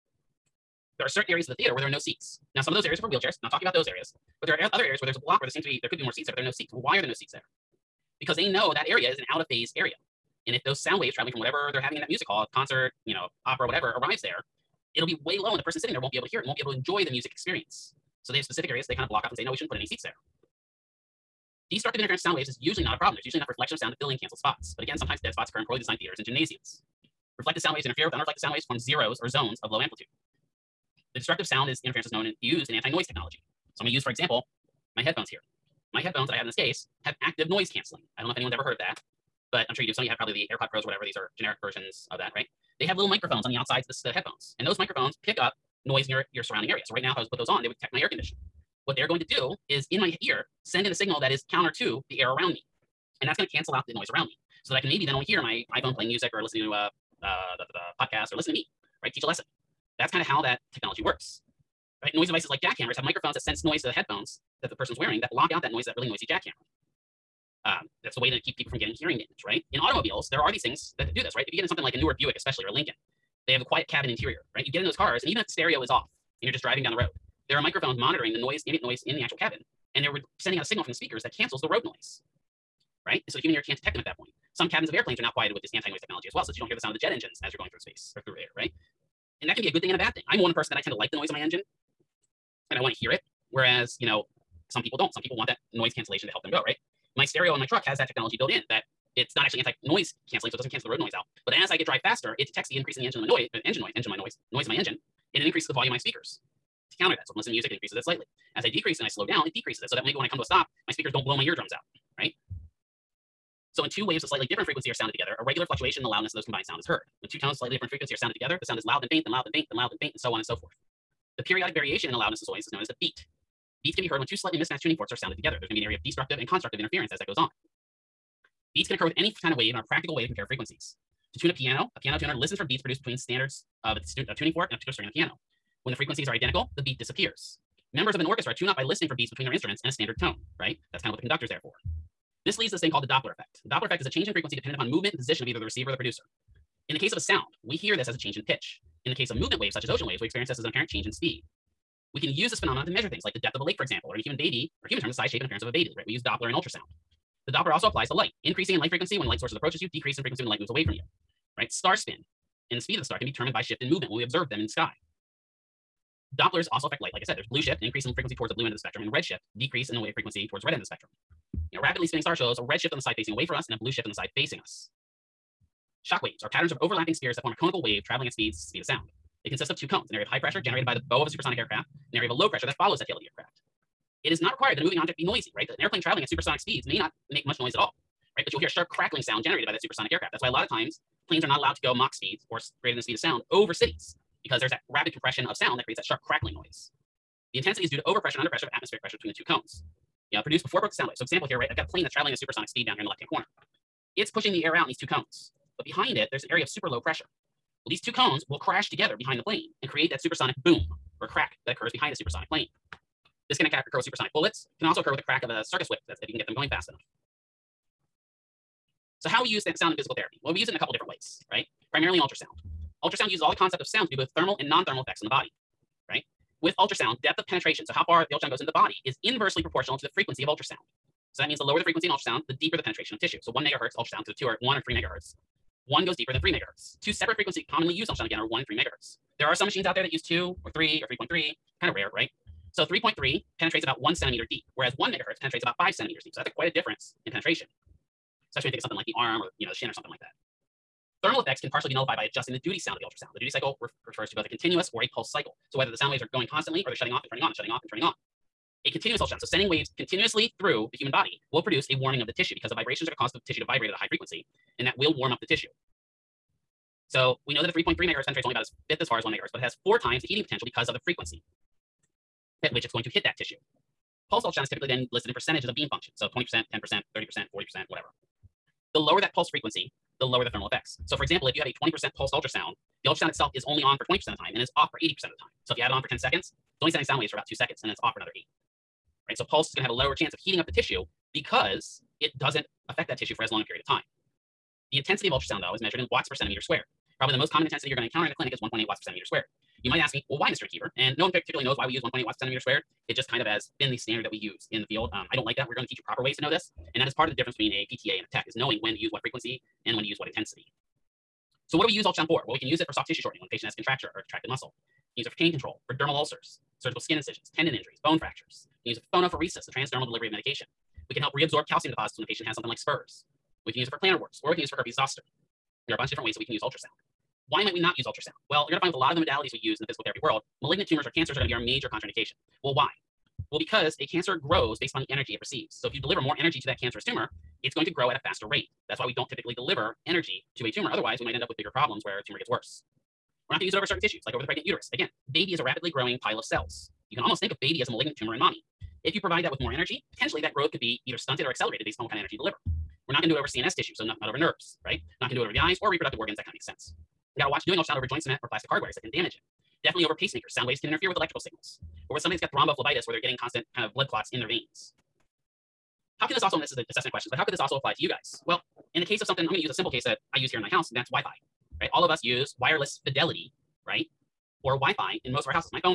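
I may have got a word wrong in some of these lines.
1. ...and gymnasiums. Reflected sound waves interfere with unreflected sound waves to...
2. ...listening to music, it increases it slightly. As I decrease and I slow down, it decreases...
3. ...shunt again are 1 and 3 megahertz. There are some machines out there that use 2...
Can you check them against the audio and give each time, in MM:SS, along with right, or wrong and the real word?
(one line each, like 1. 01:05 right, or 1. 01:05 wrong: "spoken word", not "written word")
1. 00:26 right
2. 01:47 right
3. 03:58 right.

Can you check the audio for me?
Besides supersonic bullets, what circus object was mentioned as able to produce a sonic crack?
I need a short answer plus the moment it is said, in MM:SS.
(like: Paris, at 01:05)
circus whip, at 03:35.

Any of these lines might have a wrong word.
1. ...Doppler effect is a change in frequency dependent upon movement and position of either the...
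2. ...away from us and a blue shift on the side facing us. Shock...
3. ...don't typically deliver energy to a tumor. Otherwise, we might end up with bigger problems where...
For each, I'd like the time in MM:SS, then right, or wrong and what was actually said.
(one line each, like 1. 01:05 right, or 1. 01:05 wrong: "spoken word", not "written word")
1. 02:23 right
2. 02:53 right
3. 05:39 right.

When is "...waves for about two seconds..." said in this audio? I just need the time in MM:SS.
04:47.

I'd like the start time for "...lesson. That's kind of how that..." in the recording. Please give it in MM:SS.
00:59.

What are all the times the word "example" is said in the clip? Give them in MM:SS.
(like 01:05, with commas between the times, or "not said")
00:34, 02:33, 03:21, 04:41.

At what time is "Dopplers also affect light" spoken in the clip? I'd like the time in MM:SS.
02:46.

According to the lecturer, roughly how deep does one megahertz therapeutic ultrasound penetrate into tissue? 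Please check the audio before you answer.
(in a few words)
5 centimeters.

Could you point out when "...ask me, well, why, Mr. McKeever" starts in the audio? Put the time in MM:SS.
04:59.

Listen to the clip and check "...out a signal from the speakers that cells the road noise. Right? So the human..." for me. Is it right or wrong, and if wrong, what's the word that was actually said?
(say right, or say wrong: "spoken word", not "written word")
wrong: "cancels", not "cells".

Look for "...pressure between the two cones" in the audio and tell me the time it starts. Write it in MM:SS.
03:19.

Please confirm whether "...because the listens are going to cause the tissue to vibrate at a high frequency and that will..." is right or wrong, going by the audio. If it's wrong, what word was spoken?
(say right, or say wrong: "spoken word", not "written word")
wrong: "vibrations", not "listens".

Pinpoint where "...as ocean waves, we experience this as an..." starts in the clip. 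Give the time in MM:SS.
02:29.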